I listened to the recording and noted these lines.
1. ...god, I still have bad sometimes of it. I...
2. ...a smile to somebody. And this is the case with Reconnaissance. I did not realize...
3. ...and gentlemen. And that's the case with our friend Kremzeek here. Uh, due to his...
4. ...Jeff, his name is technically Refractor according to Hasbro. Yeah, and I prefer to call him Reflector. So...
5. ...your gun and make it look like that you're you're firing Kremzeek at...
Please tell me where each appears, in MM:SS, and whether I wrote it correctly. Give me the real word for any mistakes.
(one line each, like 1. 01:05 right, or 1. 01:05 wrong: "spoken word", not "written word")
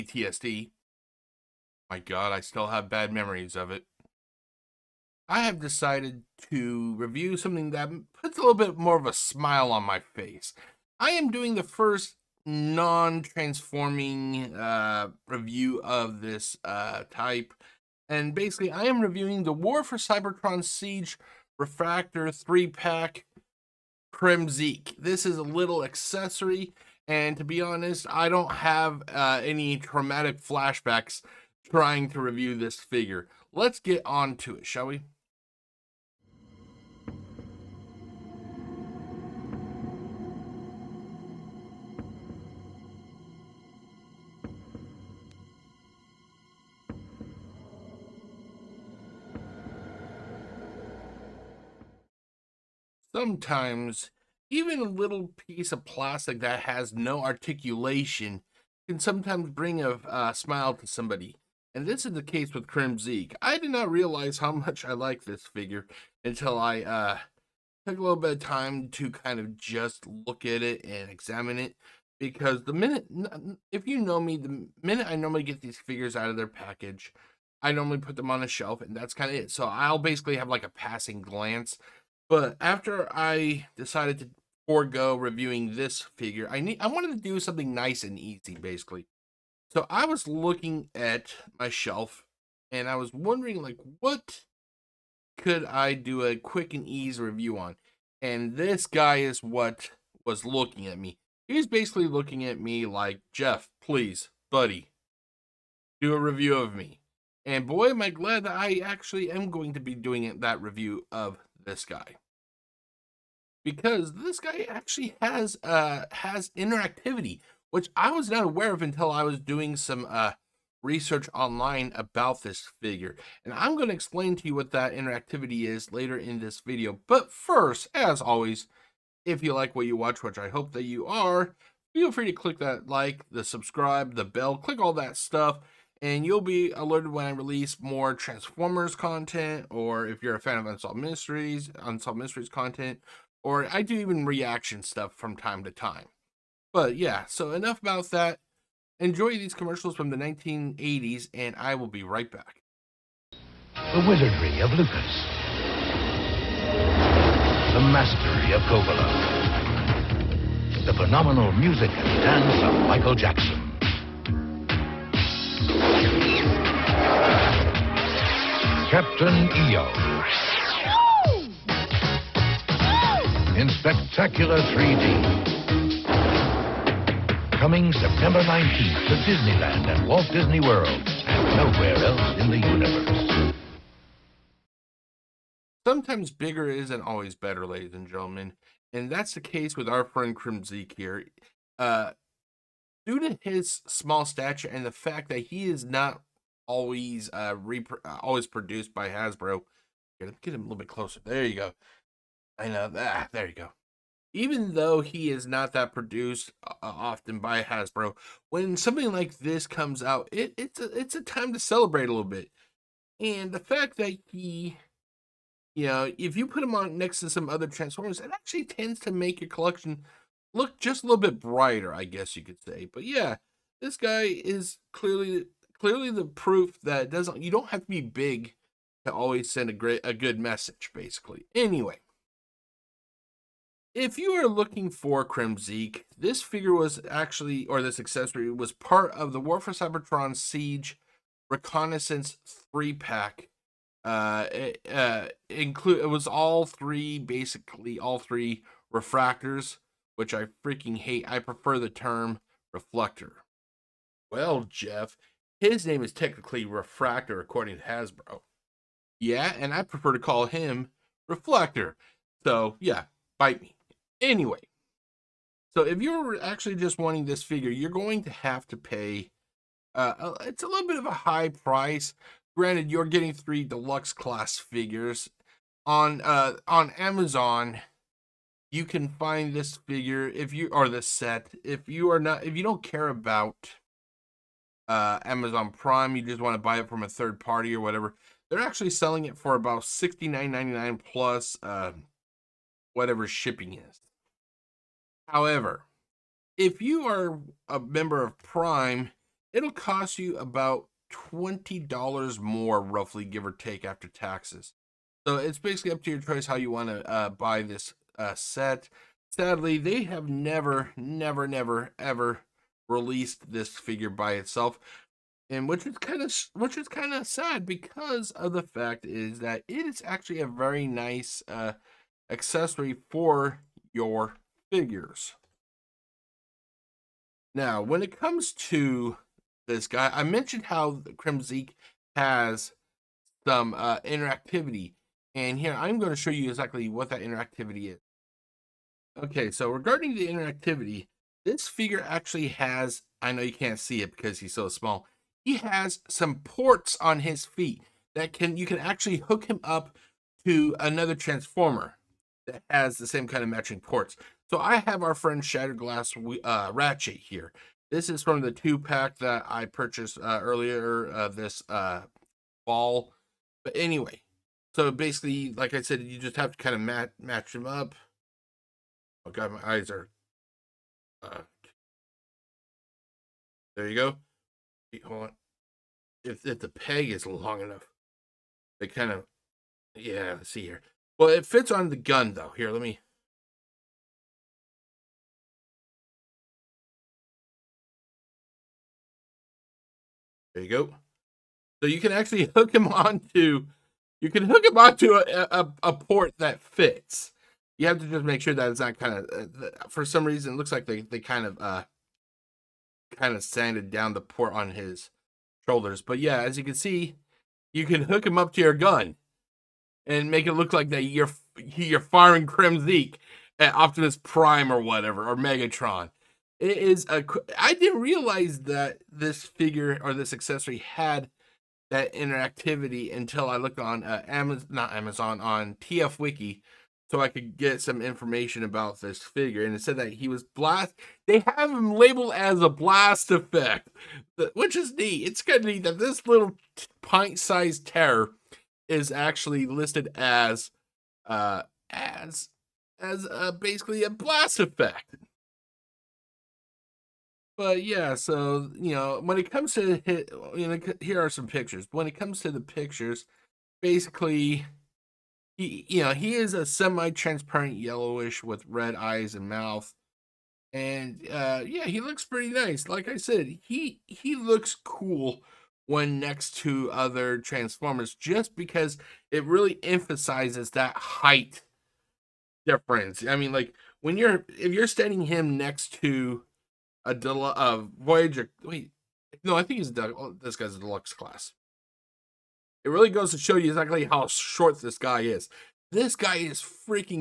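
1. 00:01 wrong: "memories", not "sometimes"
2. 00:59 wrong: "Kremzeek", not "Reconnaissance"
3. 03:07 right
4. 04:14 right
5. 06:48 right.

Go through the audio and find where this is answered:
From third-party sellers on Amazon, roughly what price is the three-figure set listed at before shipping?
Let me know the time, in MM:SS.
04:49.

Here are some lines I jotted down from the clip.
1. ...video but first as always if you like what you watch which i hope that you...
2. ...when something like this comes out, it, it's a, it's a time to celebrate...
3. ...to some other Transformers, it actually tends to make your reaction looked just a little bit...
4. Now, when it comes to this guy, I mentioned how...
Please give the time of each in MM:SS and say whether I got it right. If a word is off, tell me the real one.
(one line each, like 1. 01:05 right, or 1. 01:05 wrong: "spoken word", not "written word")
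1. 02:06 right
2. 03:28 right
3. 03:37 wrong: "collection", not "reaction"
4. 05:27 right.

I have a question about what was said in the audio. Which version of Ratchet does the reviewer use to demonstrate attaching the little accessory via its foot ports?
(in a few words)
Shattered Glass.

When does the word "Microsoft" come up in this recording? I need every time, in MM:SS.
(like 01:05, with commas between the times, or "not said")
not said.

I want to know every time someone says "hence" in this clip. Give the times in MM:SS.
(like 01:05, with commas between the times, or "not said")
not said.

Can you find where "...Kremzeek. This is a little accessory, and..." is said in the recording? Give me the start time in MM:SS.
00:24.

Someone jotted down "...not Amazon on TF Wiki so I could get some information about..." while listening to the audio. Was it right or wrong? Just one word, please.
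right.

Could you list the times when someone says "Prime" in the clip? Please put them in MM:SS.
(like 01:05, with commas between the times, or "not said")
04:45, 04:58, 06:54.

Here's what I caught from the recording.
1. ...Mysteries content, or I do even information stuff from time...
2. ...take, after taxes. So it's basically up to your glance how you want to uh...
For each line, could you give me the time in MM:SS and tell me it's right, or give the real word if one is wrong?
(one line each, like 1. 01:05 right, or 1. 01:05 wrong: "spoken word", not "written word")
1. 02:22 wrong: "reaction", not "information"
2. 05:03 wrong: "choice", not "glance".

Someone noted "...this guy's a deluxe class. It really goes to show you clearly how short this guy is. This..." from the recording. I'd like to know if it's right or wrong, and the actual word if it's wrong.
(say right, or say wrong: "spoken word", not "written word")
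wrong: "exactly", not "clearly".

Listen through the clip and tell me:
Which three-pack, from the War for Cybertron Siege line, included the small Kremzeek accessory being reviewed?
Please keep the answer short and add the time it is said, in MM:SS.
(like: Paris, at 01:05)
Reconnaissance 3 pack, at 04:01.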